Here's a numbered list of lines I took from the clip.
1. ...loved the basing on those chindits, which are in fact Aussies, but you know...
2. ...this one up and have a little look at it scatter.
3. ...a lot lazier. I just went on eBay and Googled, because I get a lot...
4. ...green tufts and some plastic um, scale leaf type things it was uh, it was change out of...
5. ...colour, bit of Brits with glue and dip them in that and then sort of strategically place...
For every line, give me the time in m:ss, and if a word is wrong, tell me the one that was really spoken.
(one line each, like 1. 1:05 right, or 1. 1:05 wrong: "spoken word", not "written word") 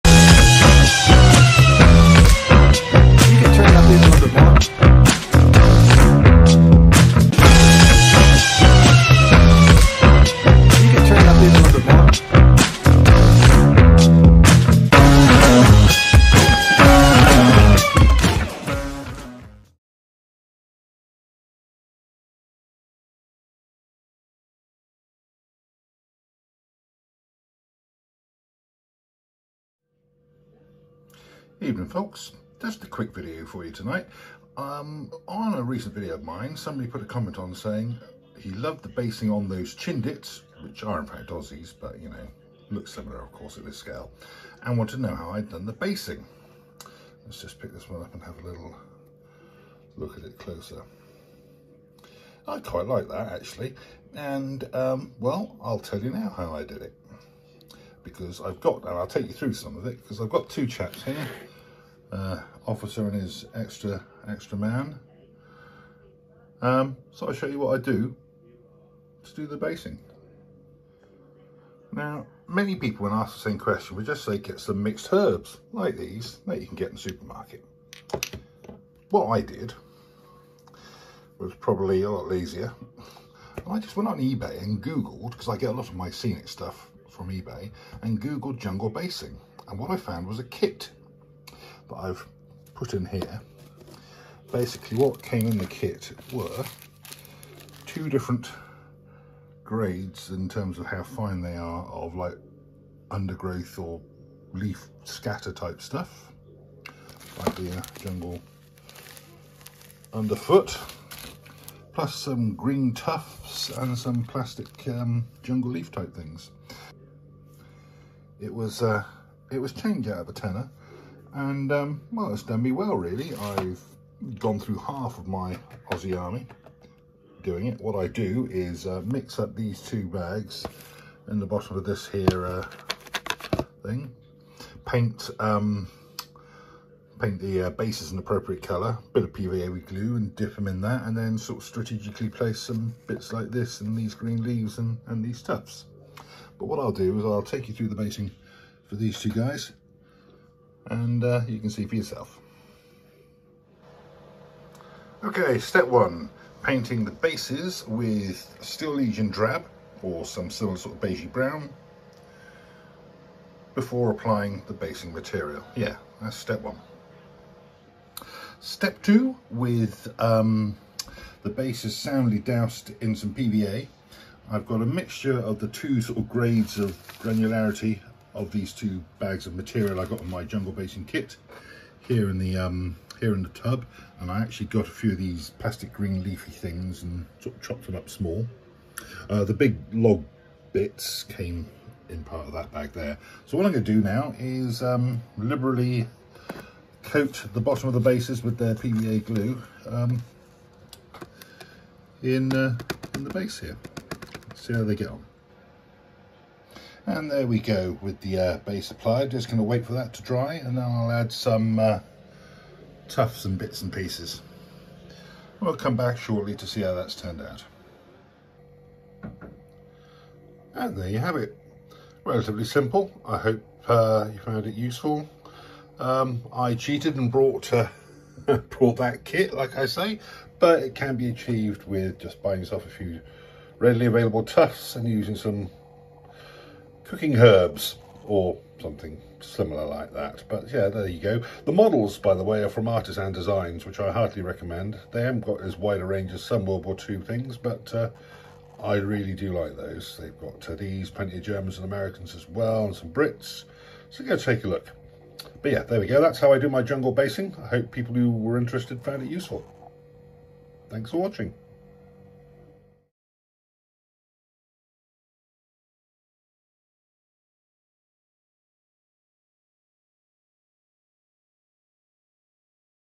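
1. 0:38 right
2. 0:47 wrong: "closer", not "scatter"
3. 1:22 right
4. 1:52 wrong: "jungle", not "scale"
5. 2:18 wrong: "PVA", not "Brits".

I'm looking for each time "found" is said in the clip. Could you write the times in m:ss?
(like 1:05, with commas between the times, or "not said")
1:29, 3:44, 4:19.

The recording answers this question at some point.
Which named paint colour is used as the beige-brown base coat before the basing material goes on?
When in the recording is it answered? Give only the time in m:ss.
2:38.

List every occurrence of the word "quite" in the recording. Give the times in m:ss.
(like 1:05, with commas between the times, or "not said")
0:52.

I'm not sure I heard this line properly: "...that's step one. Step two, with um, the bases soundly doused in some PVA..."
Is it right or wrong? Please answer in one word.
right.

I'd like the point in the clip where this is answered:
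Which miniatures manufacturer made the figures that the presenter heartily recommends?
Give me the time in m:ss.
4:02.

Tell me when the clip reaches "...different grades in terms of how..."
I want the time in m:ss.
1:38.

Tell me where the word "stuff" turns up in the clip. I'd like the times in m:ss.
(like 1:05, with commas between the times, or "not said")
1:26, 1:45.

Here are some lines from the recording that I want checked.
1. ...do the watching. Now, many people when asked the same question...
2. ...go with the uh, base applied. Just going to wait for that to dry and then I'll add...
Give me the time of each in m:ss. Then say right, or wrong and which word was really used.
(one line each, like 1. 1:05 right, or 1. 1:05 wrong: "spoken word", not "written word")
1. 1:09 wrong: "basing", not "watching"
2. 3:27 right.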